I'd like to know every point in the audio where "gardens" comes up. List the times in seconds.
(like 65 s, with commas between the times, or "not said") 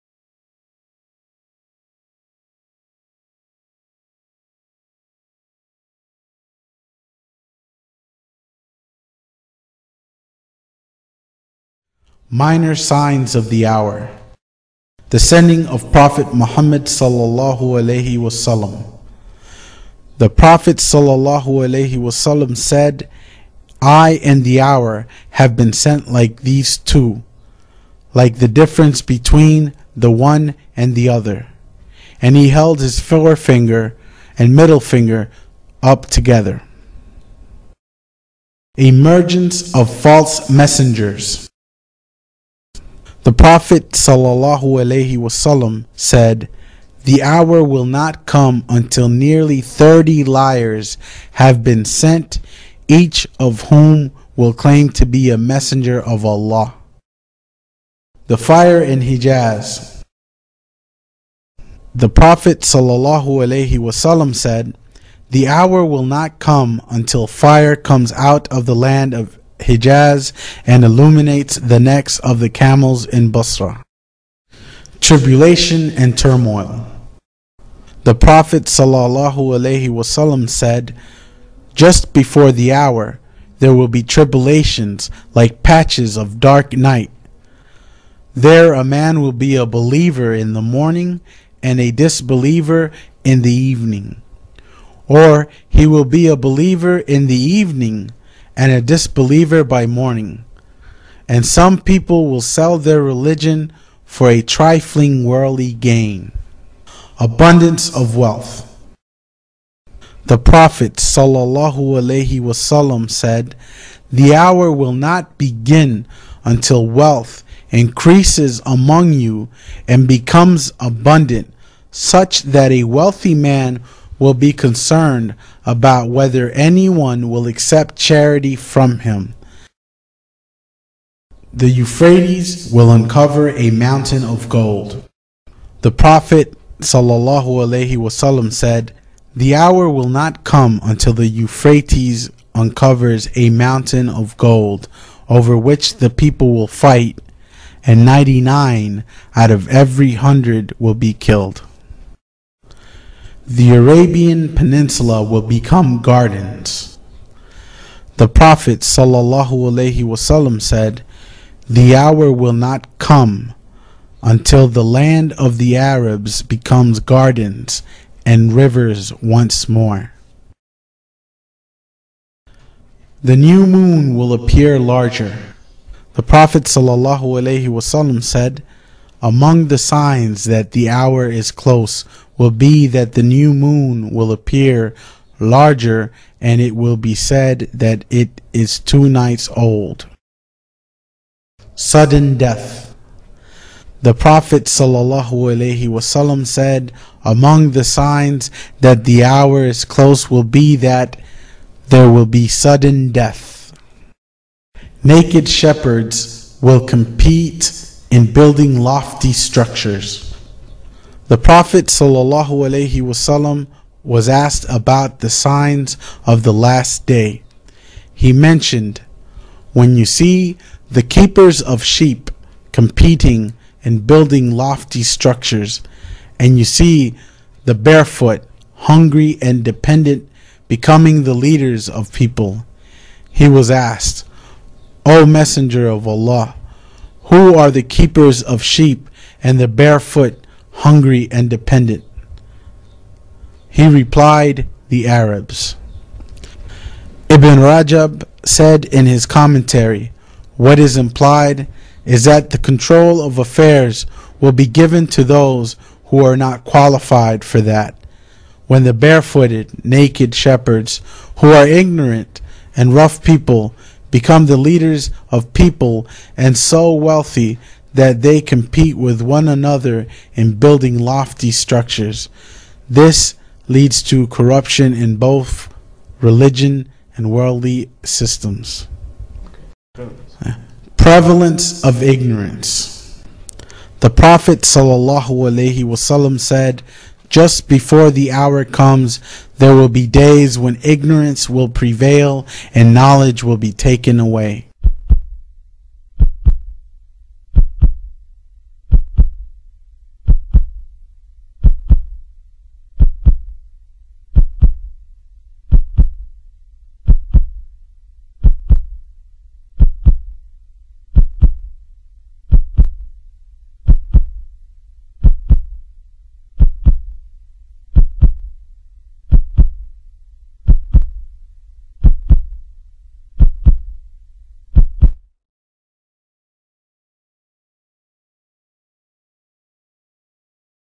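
156 s, 167 s.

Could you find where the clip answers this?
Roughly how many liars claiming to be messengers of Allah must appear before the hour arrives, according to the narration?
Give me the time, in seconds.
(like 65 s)
49 s.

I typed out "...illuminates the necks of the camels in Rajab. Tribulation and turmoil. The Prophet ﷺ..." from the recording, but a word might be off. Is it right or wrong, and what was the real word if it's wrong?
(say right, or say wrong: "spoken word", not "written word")
wrong: "Basra", not "Rajab".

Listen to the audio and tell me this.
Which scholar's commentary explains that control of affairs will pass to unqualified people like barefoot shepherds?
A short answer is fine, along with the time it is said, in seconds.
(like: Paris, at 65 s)
Ibn Rajab, at 247 s.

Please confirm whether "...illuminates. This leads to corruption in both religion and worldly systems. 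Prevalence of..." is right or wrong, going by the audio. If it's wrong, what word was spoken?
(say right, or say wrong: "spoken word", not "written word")
wrong: "structures", not "illuminates".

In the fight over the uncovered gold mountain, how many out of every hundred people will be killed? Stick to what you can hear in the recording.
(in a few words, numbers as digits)
99.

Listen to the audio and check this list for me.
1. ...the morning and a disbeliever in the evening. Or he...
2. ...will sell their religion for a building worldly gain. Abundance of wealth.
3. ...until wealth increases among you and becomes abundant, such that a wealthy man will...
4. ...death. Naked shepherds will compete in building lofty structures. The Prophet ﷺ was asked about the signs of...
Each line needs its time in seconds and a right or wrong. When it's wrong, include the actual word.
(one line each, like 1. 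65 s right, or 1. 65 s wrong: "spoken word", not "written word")
1. 90 s right
2. 102 s wrong: "trifling", not "building"
3. 116 s right
4. 203 s right.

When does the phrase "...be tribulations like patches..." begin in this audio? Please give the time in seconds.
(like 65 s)
83 s.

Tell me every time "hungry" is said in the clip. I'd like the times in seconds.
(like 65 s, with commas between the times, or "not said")
228 s, 240 s.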